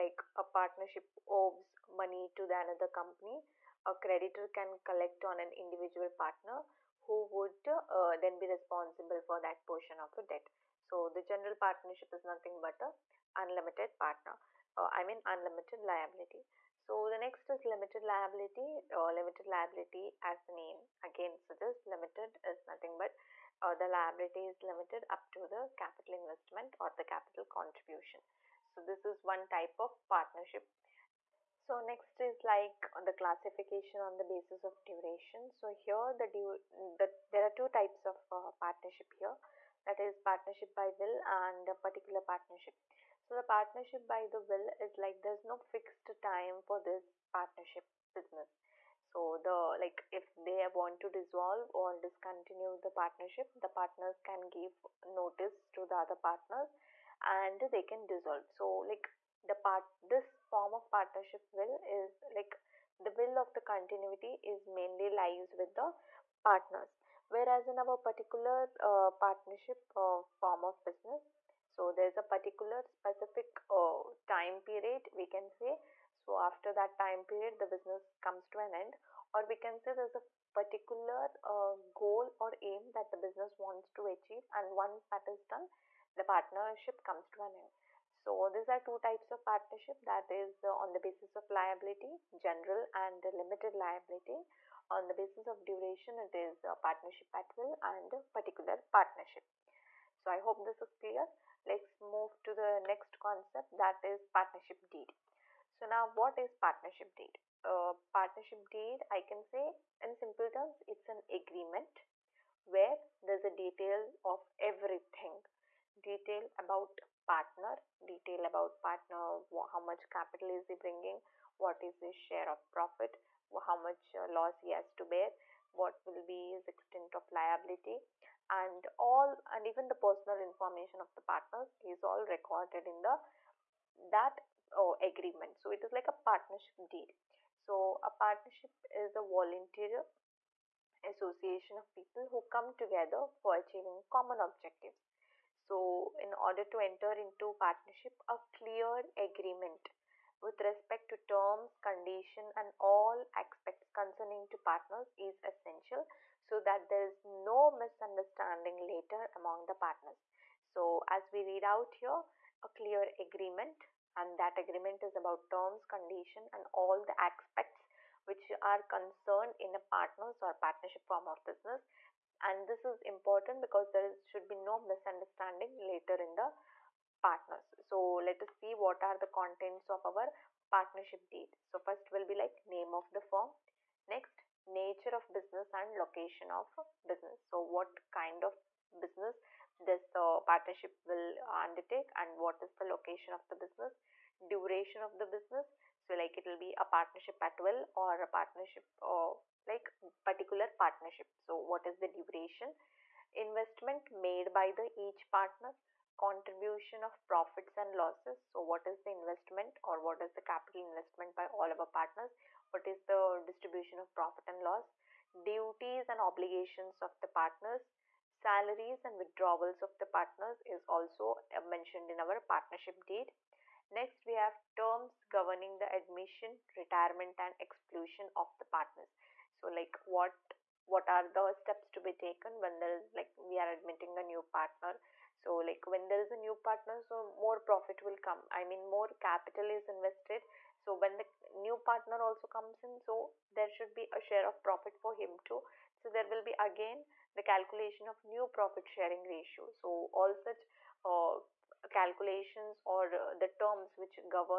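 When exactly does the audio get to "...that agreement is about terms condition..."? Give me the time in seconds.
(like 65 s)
164 s.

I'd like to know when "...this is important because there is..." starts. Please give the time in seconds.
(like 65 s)
172 s.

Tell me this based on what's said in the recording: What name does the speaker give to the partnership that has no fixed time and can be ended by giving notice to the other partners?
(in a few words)
partnership by will.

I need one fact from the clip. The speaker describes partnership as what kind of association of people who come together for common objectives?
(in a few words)
volunteer association.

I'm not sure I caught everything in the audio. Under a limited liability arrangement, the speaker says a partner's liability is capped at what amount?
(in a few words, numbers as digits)
capital contribution.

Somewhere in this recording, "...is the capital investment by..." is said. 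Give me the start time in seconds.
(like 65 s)
210 s.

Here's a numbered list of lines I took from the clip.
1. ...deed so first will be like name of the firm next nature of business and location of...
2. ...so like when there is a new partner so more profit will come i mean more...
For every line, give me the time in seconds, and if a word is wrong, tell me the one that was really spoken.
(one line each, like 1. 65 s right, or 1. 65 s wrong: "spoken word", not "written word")
1. 181 s right
2. 235 s right.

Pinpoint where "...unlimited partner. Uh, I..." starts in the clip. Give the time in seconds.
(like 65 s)
13 s.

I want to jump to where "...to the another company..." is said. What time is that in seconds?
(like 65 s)
2 s.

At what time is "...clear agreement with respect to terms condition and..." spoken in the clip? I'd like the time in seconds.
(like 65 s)
148 s.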